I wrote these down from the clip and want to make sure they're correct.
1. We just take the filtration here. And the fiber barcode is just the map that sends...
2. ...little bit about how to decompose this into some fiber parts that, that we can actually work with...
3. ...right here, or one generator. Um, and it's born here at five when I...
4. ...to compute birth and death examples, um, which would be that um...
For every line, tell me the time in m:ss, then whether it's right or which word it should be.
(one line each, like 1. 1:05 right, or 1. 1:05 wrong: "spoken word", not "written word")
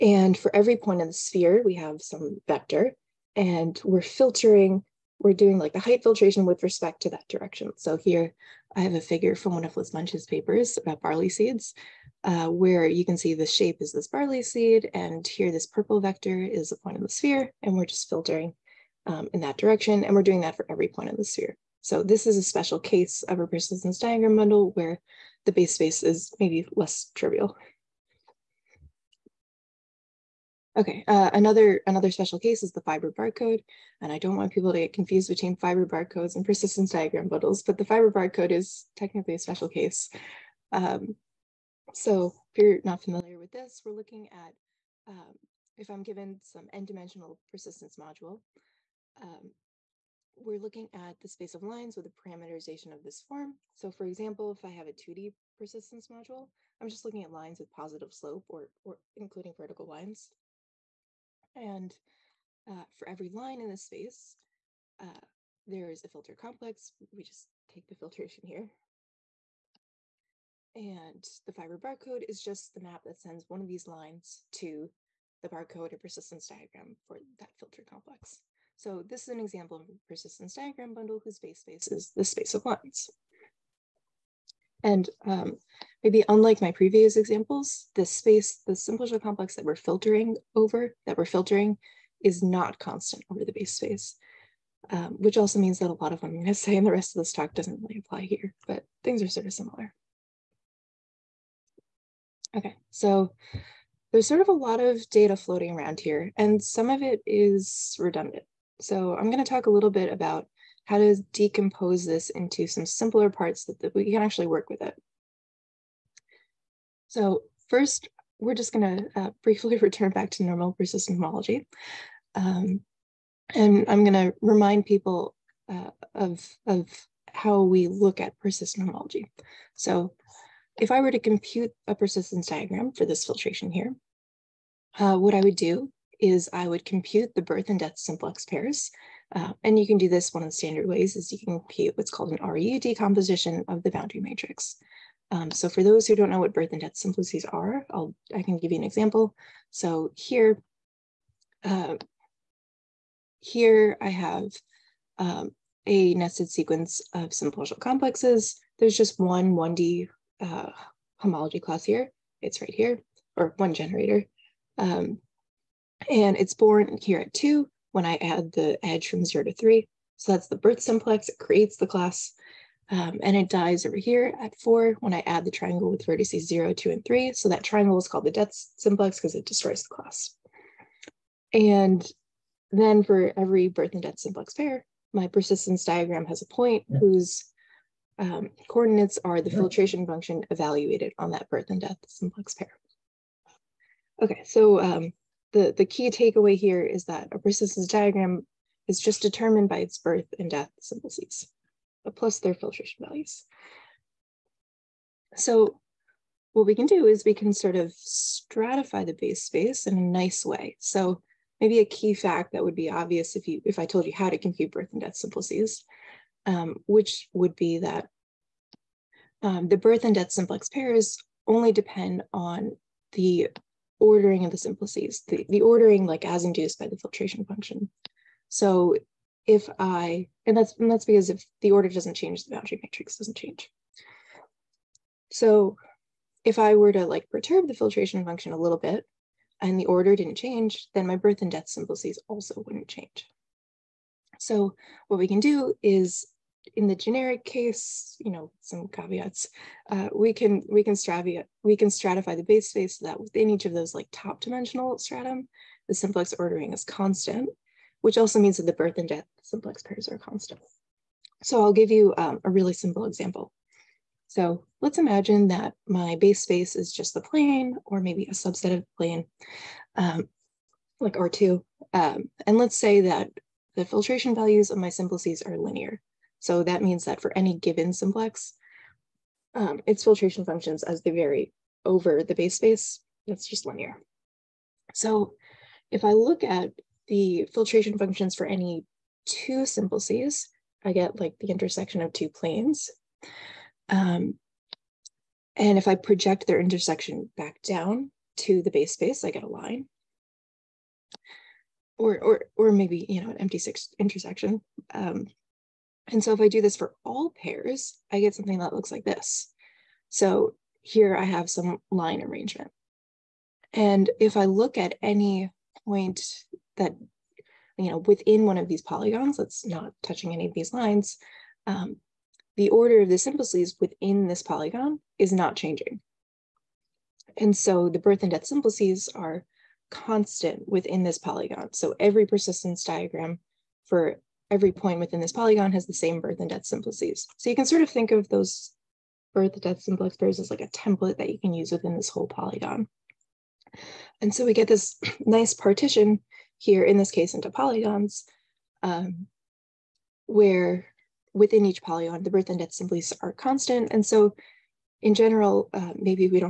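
1. 1:07 right
2. 1:49 wrong: "simpler", not "fiber"
3. 2:42 wrong: "two", not "five"
4. 3:34 wrong: "simplices", not "examples".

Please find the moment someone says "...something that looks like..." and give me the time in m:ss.
5:08.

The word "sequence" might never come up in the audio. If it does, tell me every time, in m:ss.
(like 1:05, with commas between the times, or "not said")
2:36.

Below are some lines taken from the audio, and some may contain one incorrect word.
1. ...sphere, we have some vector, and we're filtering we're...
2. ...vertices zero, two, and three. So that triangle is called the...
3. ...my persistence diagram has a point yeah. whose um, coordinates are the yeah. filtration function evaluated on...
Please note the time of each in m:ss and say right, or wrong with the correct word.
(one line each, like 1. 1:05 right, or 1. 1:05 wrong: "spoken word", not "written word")
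1. 0:01 right
2. 2:56 right
3. 3:05 right.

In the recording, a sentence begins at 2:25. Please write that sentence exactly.
Um, so for those who don't know what birth and death simplices are, I'll, I can give you an example.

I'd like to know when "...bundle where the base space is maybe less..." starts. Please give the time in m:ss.
0:24.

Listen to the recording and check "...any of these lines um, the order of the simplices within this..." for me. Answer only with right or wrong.
right.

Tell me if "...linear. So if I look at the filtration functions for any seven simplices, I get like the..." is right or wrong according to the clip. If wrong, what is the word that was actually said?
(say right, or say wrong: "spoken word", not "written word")
wrong: "two", not "seven".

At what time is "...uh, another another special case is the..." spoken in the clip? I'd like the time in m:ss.
0:31.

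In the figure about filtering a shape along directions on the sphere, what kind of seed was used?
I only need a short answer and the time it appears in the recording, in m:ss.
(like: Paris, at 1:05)
Barley seed, at 0:11.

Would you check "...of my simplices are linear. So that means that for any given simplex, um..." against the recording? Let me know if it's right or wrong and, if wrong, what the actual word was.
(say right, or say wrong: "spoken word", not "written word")
right.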